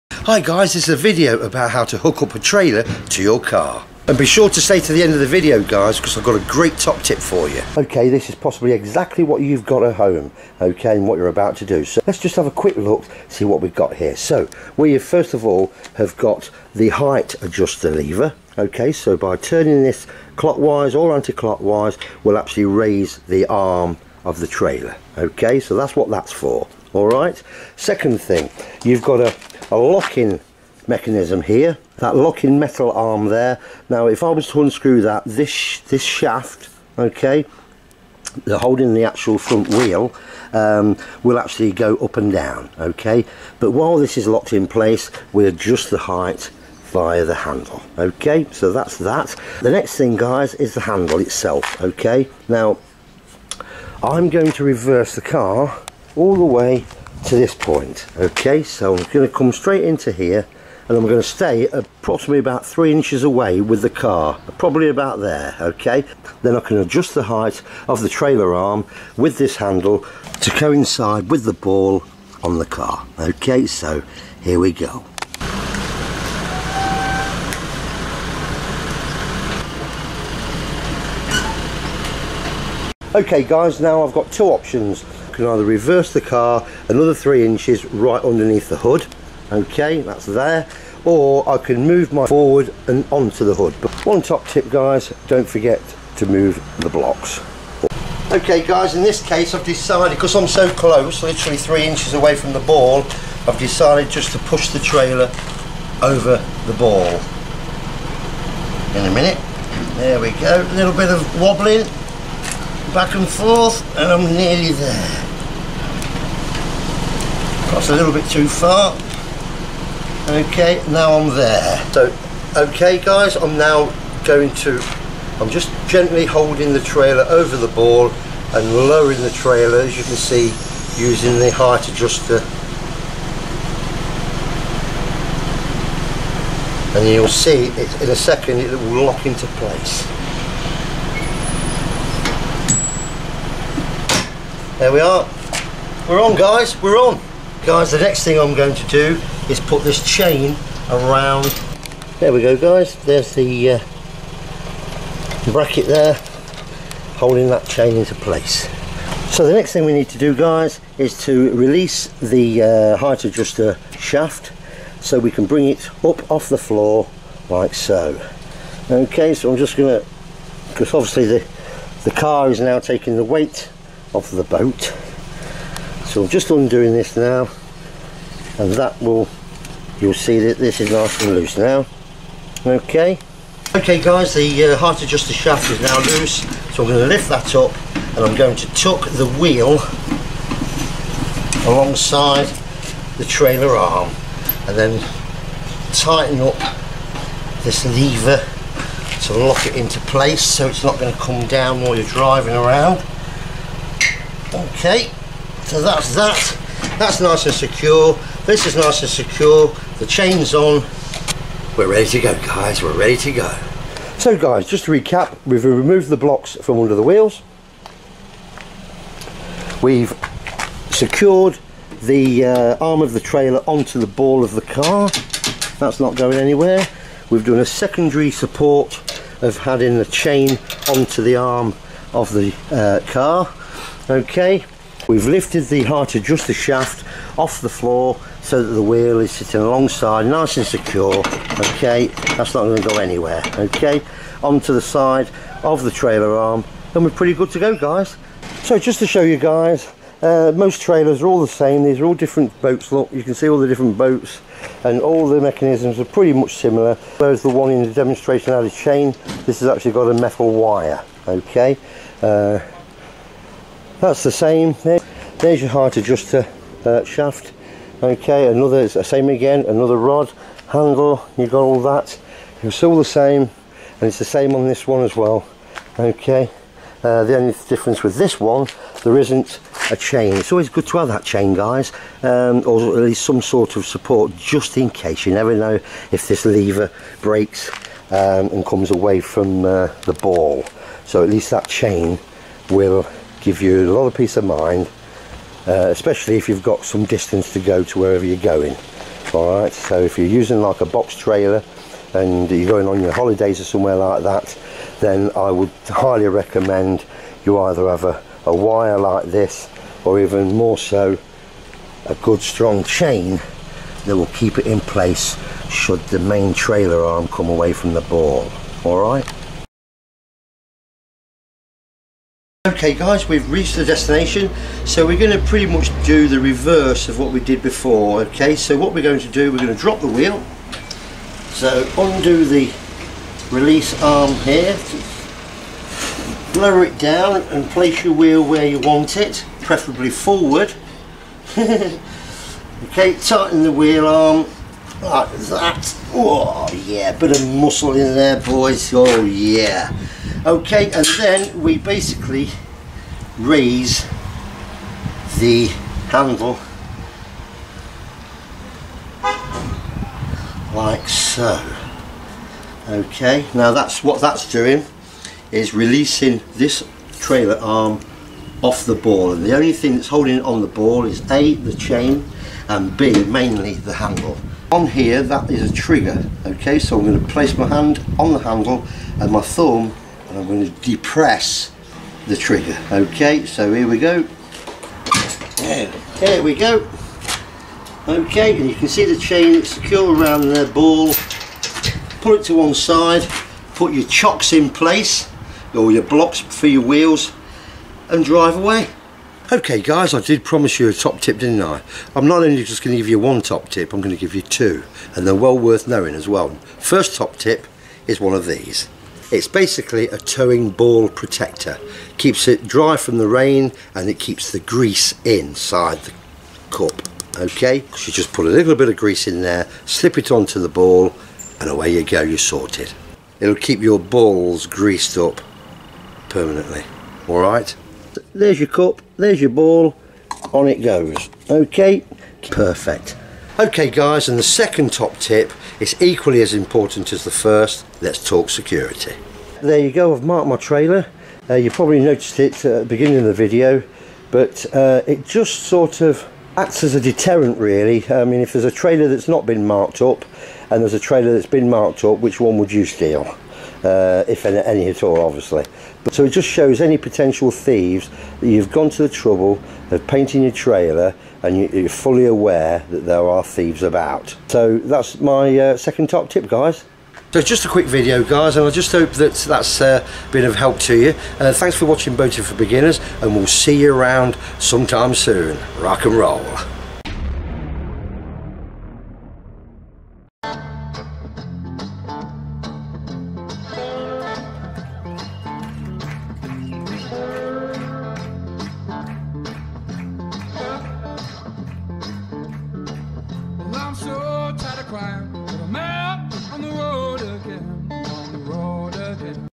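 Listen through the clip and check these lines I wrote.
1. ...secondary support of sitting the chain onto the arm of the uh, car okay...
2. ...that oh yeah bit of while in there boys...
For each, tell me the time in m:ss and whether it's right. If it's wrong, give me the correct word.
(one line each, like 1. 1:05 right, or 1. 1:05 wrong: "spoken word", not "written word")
1. 3:47 wrong: "having", not "sitting"
2. 5:45 wrong: "muscle", not "while".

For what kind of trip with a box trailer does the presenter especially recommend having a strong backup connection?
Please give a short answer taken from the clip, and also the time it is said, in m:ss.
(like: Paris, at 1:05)
holidays, at 5:03.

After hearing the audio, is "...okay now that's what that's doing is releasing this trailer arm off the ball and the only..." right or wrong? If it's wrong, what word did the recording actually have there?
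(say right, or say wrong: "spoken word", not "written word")
right.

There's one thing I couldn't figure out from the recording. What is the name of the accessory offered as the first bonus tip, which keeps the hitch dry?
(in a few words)
towing ball protector.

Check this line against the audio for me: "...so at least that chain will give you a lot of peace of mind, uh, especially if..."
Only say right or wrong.
right.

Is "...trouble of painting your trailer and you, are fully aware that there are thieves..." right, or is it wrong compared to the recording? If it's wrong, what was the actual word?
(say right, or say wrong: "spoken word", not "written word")
right.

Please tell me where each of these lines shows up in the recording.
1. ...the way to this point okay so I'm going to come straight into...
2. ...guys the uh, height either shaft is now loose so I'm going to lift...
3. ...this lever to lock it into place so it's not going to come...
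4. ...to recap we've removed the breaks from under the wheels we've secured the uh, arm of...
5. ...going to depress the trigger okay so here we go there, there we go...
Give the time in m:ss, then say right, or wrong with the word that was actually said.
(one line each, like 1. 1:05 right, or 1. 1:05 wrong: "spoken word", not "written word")
1. 0:56 right
2. 3:04 wrong: "adjuster", not "either"
3. 3:17 right
4. 3:34 wrong: "blocks", not "breaks"
5. 6:20 right.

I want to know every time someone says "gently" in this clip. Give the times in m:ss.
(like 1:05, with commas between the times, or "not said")
2:05.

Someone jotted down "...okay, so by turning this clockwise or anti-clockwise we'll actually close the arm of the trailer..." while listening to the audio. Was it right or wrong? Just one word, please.
wrong.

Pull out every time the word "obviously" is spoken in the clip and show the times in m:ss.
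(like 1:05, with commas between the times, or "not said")
2:50, 7:35.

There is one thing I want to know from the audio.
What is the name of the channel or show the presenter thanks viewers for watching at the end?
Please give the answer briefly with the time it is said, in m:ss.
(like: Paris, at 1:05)
Boating for Beginners, at 7:52.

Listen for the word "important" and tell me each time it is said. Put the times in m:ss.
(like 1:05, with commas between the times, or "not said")
7:16.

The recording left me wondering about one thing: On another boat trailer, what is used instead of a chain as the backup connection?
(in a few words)
metal wire.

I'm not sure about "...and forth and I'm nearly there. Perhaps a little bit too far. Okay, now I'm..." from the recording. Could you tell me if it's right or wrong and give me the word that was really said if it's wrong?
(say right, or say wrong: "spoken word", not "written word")
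right.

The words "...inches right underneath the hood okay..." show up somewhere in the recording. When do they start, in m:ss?
1:27.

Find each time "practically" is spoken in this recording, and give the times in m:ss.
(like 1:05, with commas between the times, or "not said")
not said.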